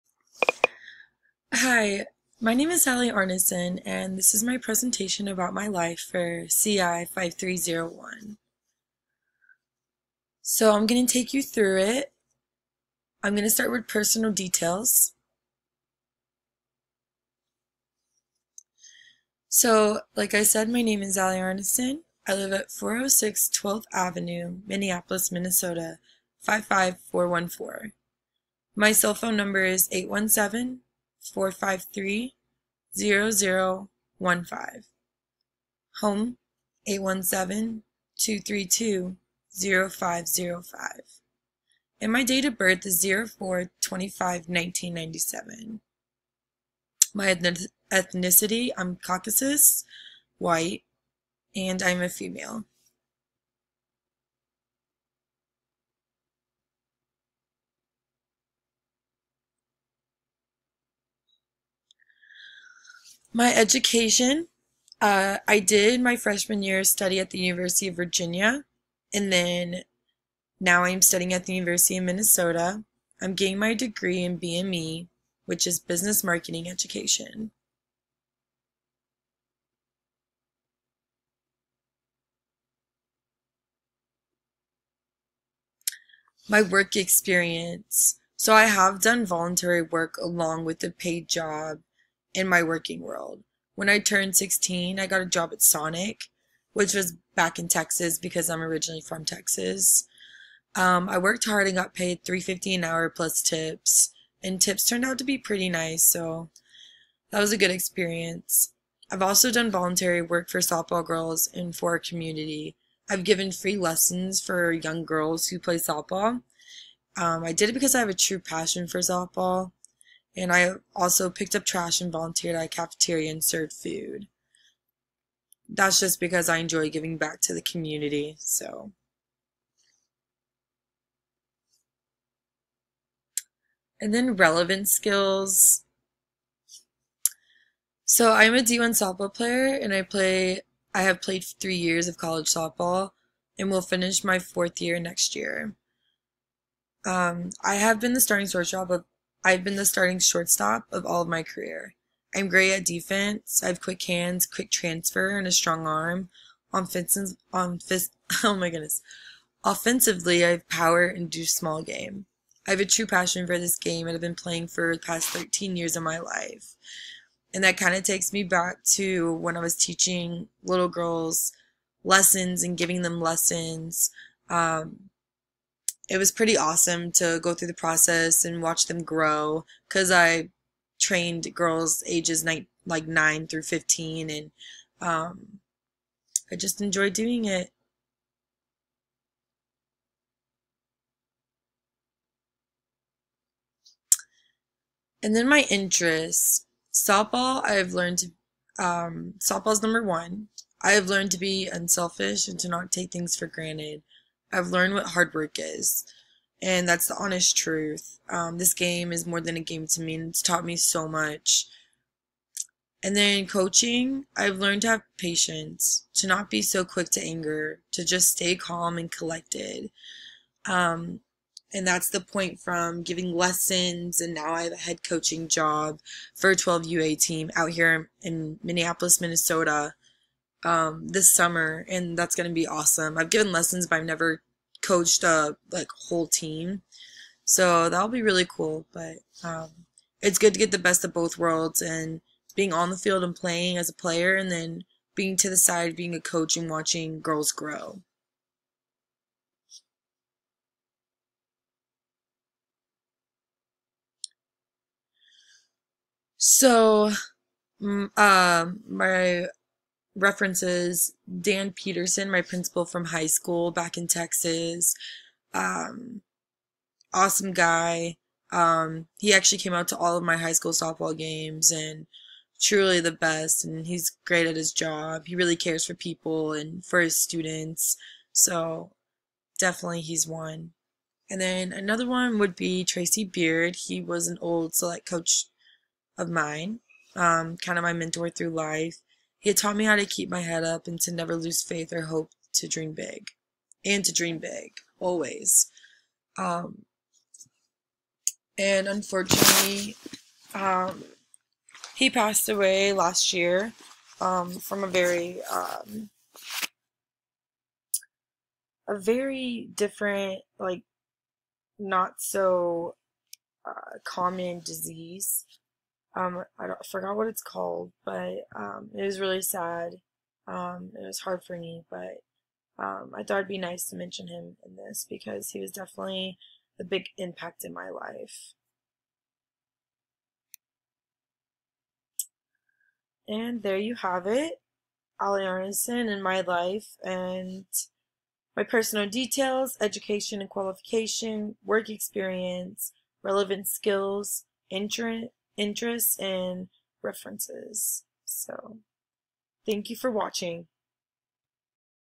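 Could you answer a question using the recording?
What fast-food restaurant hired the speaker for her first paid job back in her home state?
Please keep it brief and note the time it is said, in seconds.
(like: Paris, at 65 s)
Sonic, at 95 s.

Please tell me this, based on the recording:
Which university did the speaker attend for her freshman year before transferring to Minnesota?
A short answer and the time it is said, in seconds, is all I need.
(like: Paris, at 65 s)
University of Virginia, at 67 s.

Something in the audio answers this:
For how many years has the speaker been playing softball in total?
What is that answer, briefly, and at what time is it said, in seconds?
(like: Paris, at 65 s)
13 years, at 165 s.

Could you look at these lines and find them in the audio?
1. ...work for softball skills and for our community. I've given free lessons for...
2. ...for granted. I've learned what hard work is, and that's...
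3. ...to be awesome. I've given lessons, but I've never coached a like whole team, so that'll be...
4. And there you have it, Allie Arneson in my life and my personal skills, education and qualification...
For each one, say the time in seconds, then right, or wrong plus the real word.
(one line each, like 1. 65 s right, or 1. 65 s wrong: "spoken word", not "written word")
1. 110 s wrong: "girls", not "skills"
2. 203 s right
3. 232 s right
4. 333 s wrong: "details", not "skills".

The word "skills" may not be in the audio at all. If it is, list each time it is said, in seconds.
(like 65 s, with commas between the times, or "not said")
134 s, 343 s.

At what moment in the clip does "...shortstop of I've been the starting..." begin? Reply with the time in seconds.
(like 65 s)
148 s.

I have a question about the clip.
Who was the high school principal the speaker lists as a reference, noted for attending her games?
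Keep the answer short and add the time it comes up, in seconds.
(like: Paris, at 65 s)
Dan Peterson, at 261 s.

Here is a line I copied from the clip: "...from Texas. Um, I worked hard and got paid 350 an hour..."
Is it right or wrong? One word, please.
right.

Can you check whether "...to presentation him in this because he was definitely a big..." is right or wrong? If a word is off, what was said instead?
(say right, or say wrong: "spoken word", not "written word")
wrong: "mention", not "presentation".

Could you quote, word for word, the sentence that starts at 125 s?
That's just because I enjoy giving back to the community, so.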